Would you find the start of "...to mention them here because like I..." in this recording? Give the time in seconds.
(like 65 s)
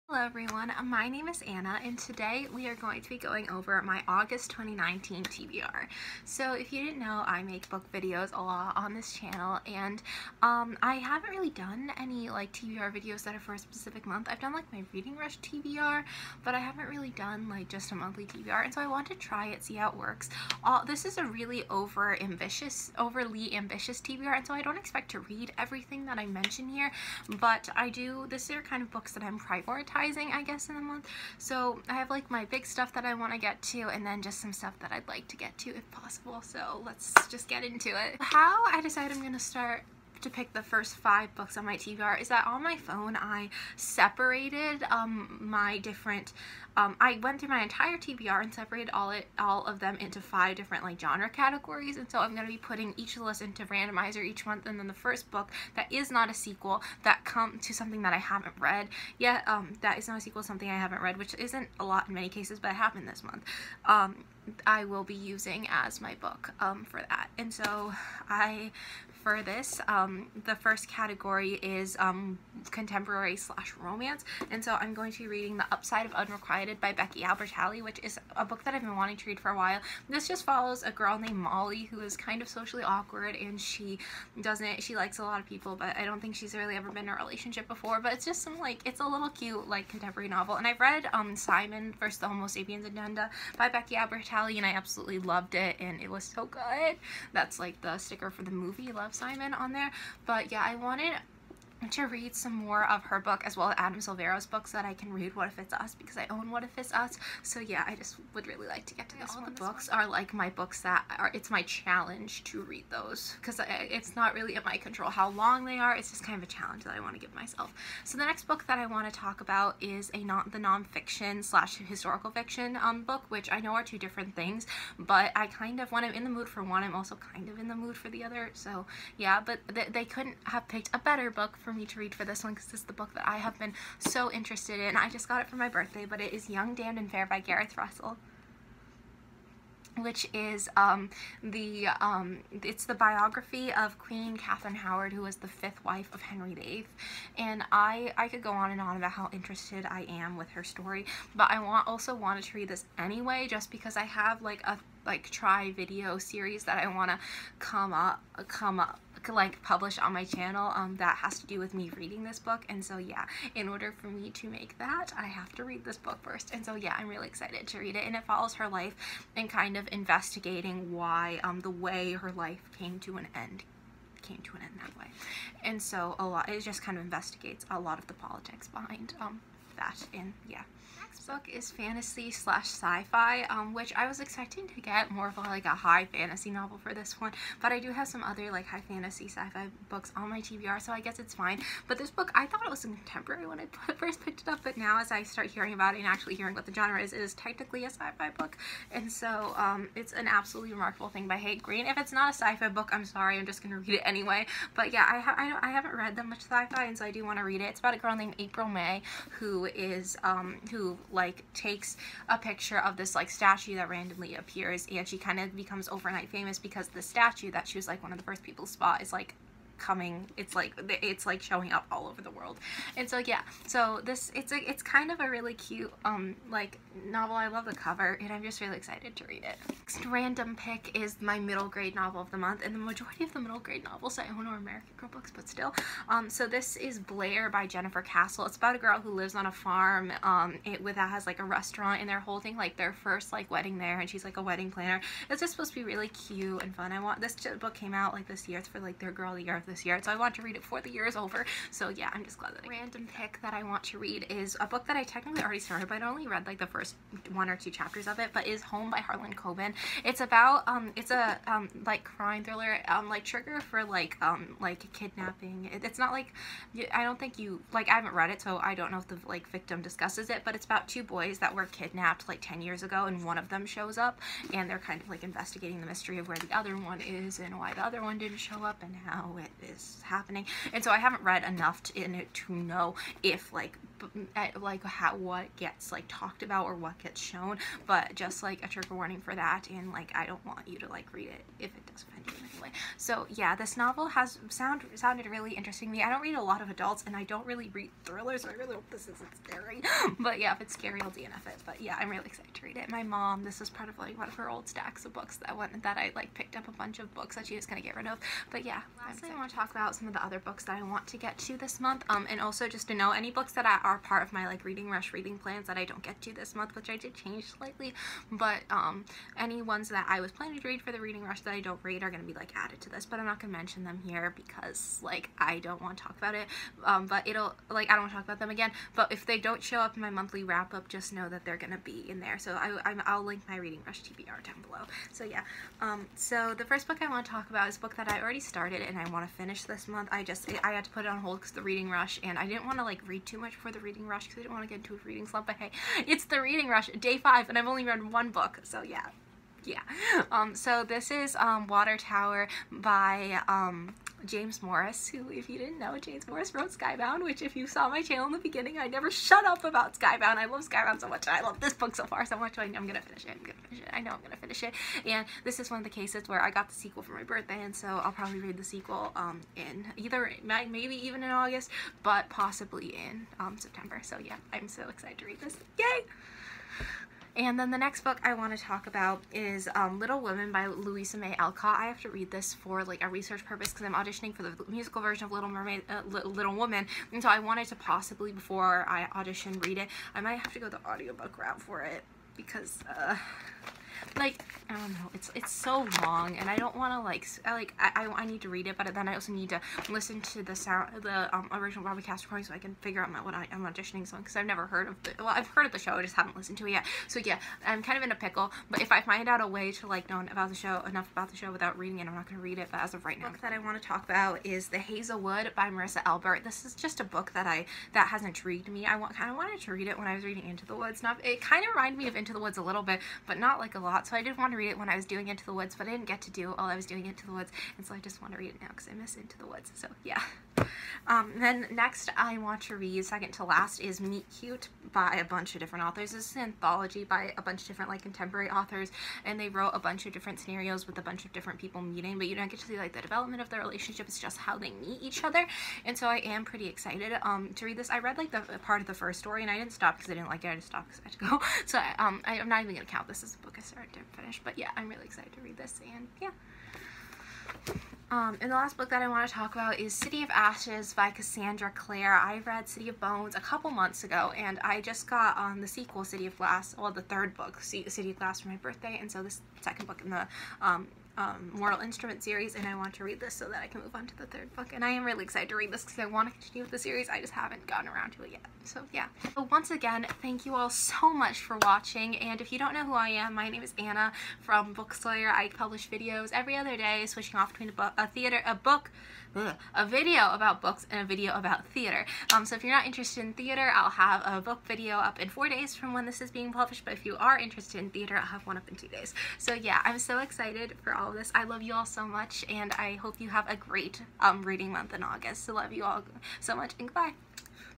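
323 s.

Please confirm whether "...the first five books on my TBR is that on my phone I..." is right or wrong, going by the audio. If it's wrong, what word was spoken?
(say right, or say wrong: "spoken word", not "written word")
right.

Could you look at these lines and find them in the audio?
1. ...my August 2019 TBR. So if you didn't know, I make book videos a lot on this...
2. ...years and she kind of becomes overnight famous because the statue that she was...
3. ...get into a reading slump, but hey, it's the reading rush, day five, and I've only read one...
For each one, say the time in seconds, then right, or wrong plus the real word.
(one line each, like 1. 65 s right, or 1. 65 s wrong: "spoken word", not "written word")
1. 3 s right
2. 214 s wrong: "appears", not "years"
3. 344 s right.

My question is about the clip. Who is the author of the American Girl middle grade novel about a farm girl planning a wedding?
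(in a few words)
Jennifer Castle.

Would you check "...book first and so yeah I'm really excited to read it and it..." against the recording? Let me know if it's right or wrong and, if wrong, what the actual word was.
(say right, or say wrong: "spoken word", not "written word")
right.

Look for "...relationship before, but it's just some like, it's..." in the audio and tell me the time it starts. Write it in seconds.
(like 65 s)
87 s.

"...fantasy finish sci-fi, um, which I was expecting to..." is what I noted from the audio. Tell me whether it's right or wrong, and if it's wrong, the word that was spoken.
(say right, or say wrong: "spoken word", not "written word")
wrong: "slash", not "finish".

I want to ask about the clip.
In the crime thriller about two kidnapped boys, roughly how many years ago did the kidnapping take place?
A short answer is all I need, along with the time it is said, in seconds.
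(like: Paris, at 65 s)
10, at 272 s.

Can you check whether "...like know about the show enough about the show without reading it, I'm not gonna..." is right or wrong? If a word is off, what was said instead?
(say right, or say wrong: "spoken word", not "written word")
right.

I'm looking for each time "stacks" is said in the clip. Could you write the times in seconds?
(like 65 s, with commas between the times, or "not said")
304 s.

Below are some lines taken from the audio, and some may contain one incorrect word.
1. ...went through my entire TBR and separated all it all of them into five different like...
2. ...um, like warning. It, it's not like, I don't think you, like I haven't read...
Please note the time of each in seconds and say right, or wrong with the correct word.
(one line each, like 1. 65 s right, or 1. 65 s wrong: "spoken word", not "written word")
1. 47 s right
2. 264 s wrong: "kidnapping", not "warning".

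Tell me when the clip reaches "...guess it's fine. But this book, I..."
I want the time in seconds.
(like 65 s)
191 s.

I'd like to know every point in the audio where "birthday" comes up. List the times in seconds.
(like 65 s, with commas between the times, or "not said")
135 s, 367 s, 468 s.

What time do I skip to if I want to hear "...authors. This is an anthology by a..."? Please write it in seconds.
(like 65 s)
435 s.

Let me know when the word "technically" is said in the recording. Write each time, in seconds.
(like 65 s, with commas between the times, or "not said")
197 s, 255 s.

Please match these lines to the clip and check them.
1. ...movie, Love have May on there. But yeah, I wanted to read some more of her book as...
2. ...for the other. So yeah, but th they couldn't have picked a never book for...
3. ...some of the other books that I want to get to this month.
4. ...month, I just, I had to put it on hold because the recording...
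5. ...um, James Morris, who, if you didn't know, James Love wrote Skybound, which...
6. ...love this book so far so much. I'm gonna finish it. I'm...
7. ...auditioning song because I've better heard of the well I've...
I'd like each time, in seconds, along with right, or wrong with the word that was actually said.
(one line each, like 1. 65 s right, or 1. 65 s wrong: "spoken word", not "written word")
1. 98 s wrong: "Simon", not "May"
2. 127 s wrong: "better", not "never"
3. 309 s right
4. 339 s wrong: "reading", not "recording"
5. 353 s wrong: "Morris", not "Love"
6. 361 s right
7. 403 s wrong: "never", not "better".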